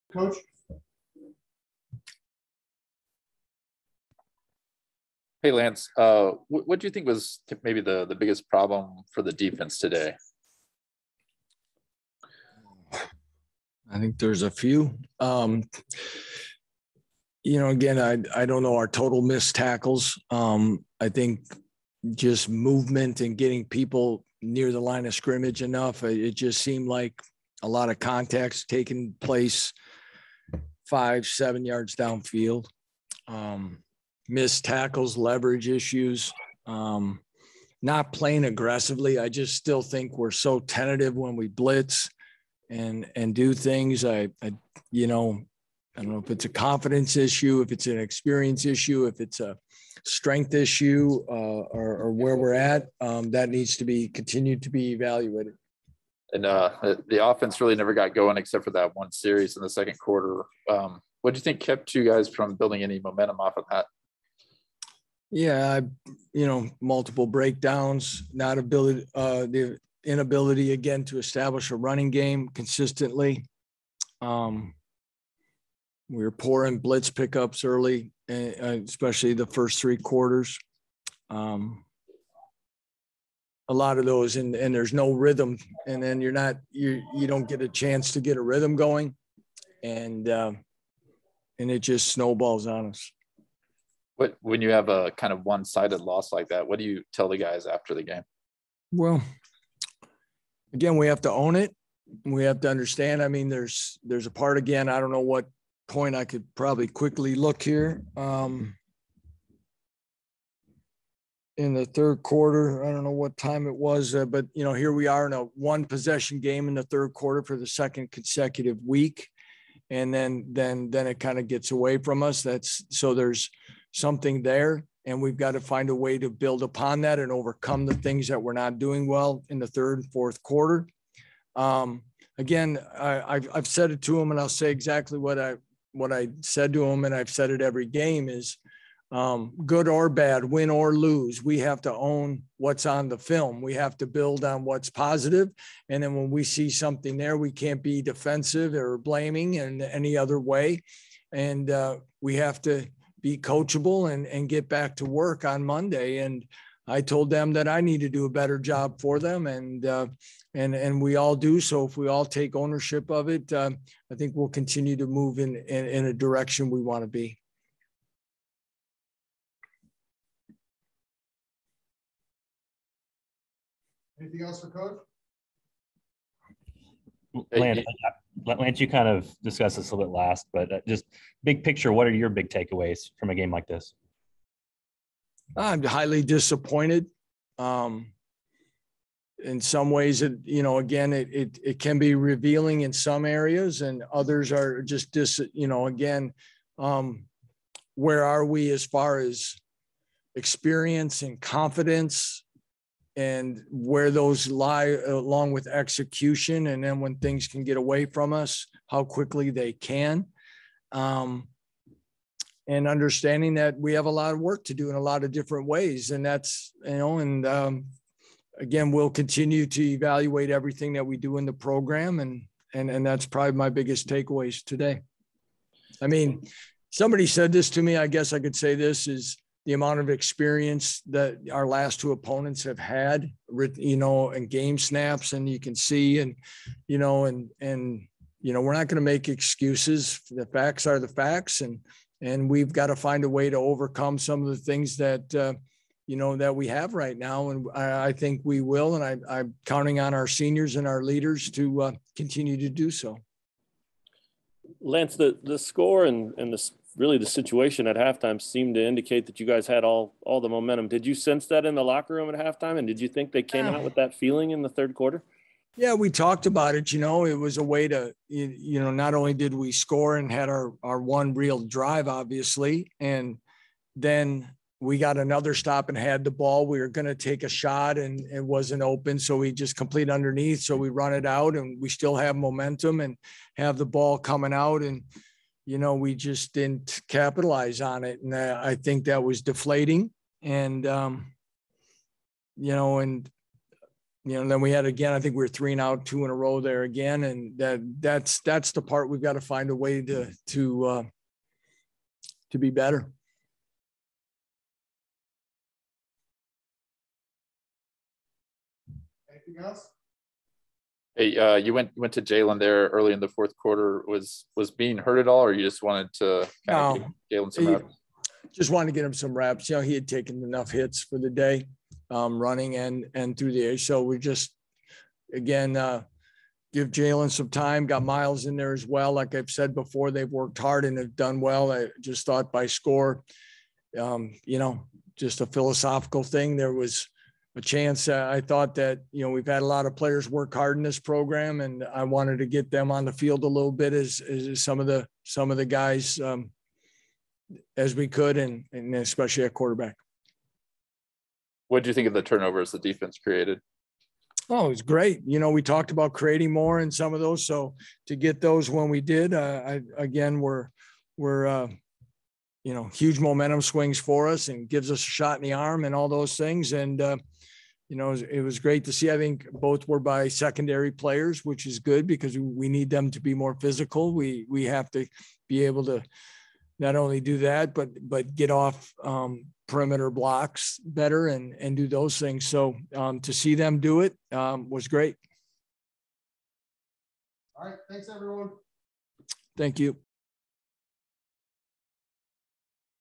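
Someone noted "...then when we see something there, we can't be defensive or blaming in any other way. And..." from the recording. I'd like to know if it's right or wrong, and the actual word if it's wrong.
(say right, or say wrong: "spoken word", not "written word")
right.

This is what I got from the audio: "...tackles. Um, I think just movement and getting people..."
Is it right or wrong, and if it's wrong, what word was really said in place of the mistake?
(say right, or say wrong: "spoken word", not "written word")
right.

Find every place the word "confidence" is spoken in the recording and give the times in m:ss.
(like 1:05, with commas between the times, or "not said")
0:46, 3:21.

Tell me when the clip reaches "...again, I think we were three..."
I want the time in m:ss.
4:54.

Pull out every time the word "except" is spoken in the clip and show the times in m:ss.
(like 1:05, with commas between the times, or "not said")
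0:58.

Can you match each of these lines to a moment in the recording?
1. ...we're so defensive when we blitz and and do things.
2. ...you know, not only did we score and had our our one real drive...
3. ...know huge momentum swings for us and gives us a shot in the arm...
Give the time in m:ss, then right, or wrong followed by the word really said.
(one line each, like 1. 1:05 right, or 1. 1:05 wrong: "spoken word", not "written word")
1. 0:40 wrong: "tentative", not "defensive"
2. 4:28 right
3. 6:02 right.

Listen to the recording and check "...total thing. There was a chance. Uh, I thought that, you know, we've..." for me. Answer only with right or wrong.
wrong.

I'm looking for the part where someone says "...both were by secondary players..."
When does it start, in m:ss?
6:09.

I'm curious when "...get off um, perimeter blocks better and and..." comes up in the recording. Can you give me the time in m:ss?
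6:18.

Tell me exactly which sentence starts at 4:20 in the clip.
Did you sense that in the locker room at halftime, and did you think they came uh.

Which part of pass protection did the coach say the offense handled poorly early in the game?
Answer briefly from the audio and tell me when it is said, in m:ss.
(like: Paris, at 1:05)
Blitz pickups, at 1:16.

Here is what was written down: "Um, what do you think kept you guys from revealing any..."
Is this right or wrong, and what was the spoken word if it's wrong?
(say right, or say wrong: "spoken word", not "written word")
wrong: "building", not "revealing".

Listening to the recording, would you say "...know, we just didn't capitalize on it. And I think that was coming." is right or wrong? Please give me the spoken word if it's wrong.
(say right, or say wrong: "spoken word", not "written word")
wrong: "deflating", not "coming".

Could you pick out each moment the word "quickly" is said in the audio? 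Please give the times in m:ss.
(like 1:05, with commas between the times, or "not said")
1:46, 3:29.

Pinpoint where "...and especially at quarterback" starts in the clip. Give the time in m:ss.
5:48.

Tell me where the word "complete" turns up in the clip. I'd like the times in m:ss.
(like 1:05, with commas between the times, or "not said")
4:39.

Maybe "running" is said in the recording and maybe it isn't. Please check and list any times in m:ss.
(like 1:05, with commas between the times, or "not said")
1:11, 5:22.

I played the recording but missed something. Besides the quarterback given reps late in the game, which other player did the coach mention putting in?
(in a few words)
Miles.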